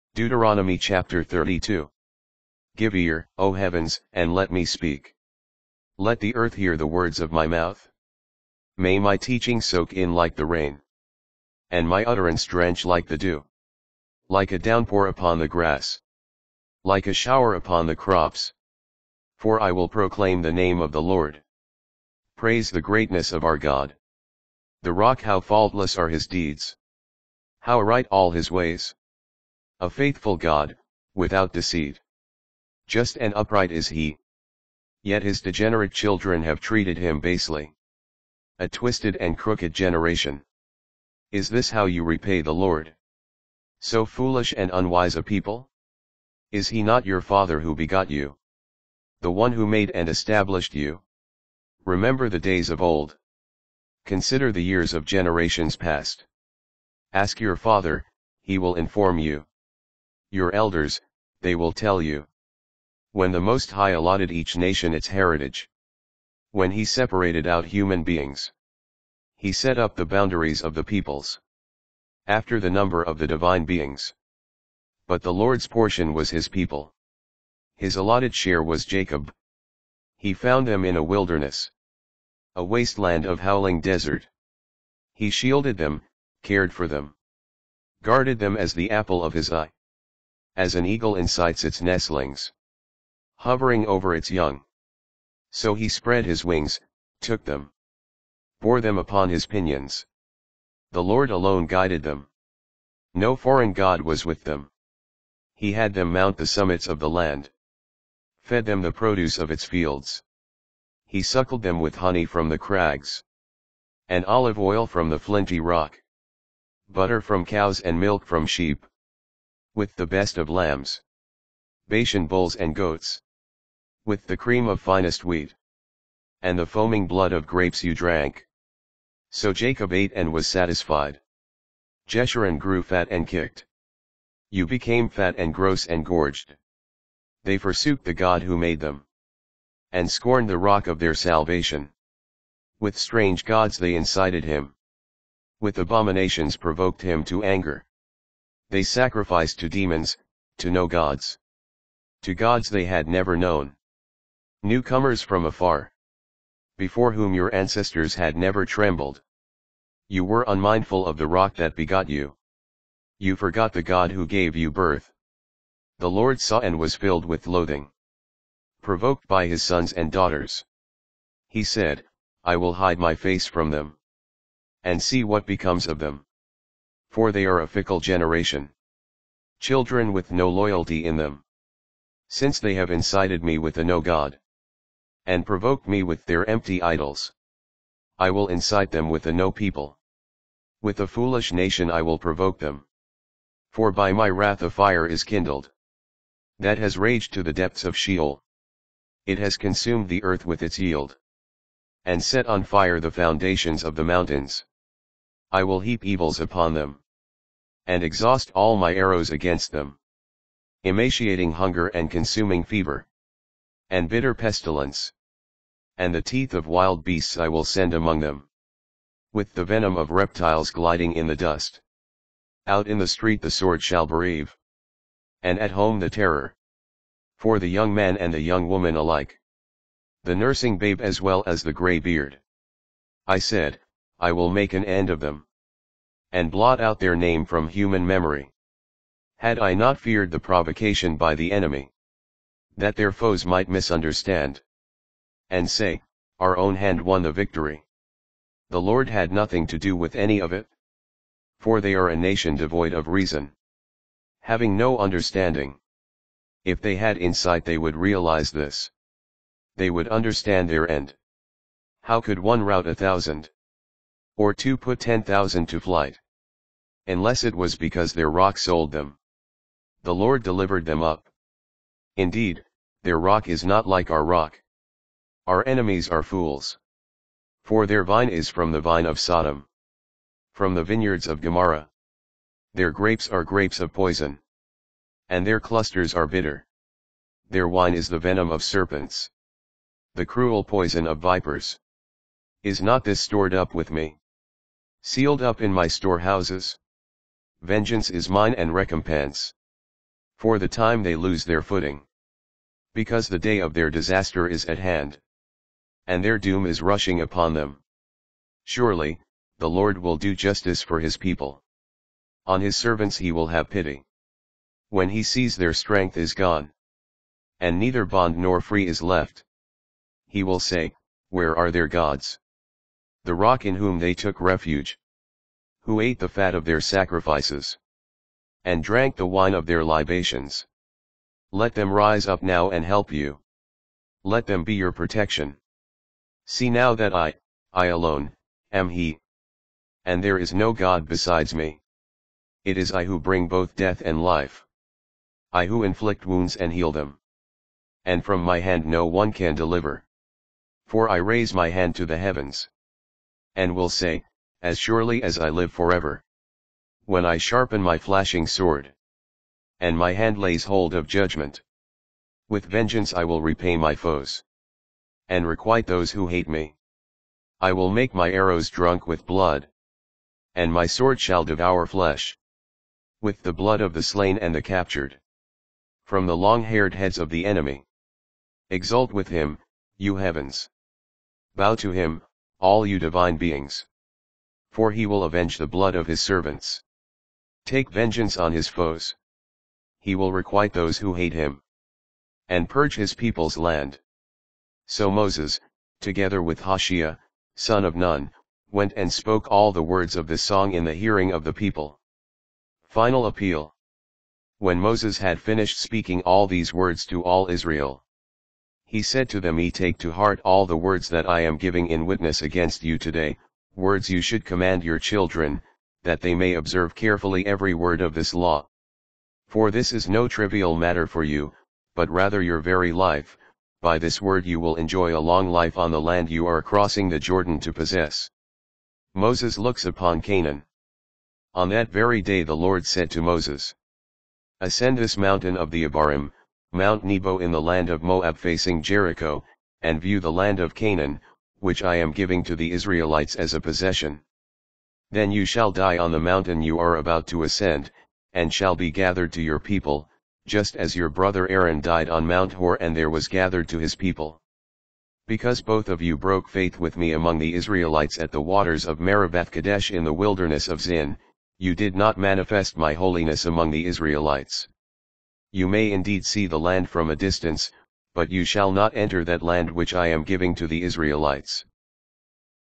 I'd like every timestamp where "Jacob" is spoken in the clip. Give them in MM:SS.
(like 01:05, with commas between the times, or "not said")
01:18, 02:09.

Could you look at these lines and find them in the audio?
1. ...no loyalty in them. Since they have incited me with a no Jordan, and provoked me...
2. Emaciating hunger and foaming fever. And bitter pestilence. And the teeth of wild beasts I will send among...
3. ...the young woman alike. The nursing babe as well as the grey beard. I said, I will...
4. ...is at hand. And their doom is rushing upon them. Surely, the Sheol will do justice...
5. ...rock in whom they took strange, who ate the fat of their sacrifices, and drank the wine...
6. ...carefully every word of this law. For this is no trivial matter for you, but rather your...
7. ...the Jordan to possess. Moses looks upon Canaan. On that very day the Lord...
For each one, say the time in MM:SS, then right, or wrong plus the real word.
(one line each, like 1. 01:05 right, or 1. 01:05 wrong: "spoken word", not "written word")
1. 03:00 wrong: "God", not "Jordan"
2. 03:30 wrong: "consuming", not "foaming"
3. 03:48 right
4. 05:04 wrong: "Lord", not "Sheol"
5. 05:23 wrong: "refuge", not "strange"
6. 06:56 right
7. 07:07 right.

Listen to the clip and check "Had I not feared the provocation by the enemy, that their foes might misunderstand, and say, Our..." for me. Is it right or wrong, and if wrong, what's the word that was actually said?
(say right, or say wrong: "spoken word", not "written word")
right.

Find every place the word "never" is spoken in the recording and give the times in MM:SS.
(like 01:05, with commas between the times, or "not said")
02:33, 02:38.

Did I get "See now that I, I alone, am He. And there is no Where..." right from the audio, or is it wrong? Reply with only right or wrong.
wrong.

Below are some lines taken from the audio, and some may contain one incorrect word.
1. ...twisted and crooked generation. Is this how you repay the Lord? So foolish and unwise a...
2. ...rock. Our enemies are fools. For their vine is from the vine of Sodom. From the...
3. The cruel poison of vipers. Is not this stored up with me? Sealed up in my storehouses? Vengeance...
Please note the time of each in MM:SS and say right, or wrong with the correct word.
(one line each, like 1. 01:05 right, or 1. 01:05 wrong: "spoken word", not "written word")
1. 00:38 right
2. 04:34 right
3. 04:50 right.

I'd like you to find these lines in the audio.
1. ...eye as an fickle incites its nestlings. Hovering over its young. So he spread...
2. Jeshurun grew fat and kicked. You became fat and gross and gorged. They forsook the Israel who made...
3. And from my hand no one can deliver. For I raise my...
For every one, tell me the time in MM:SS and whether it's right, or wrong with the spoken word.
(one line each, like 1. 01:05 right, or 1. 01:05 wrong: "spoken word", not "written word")
1. 01:29 wrong: "eagle", not "fickle"
2. 02:12 wrong: "God", not "Israel"
3. 05:48 right.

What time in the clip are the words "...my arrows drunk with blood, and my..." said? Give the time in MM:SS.
06:08.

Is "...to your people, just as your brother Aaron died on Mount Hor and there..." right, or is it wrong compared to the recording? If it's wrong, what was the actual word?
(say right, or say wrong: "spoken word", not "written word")
right.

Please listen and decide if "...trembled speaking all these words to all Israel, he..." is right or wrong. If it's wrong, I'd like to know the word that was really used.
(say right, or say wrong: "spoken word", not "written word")
wrong: "finished", not "trembled".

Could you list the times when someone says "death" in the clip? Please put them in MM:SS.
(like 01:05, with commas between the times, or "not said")
05:43.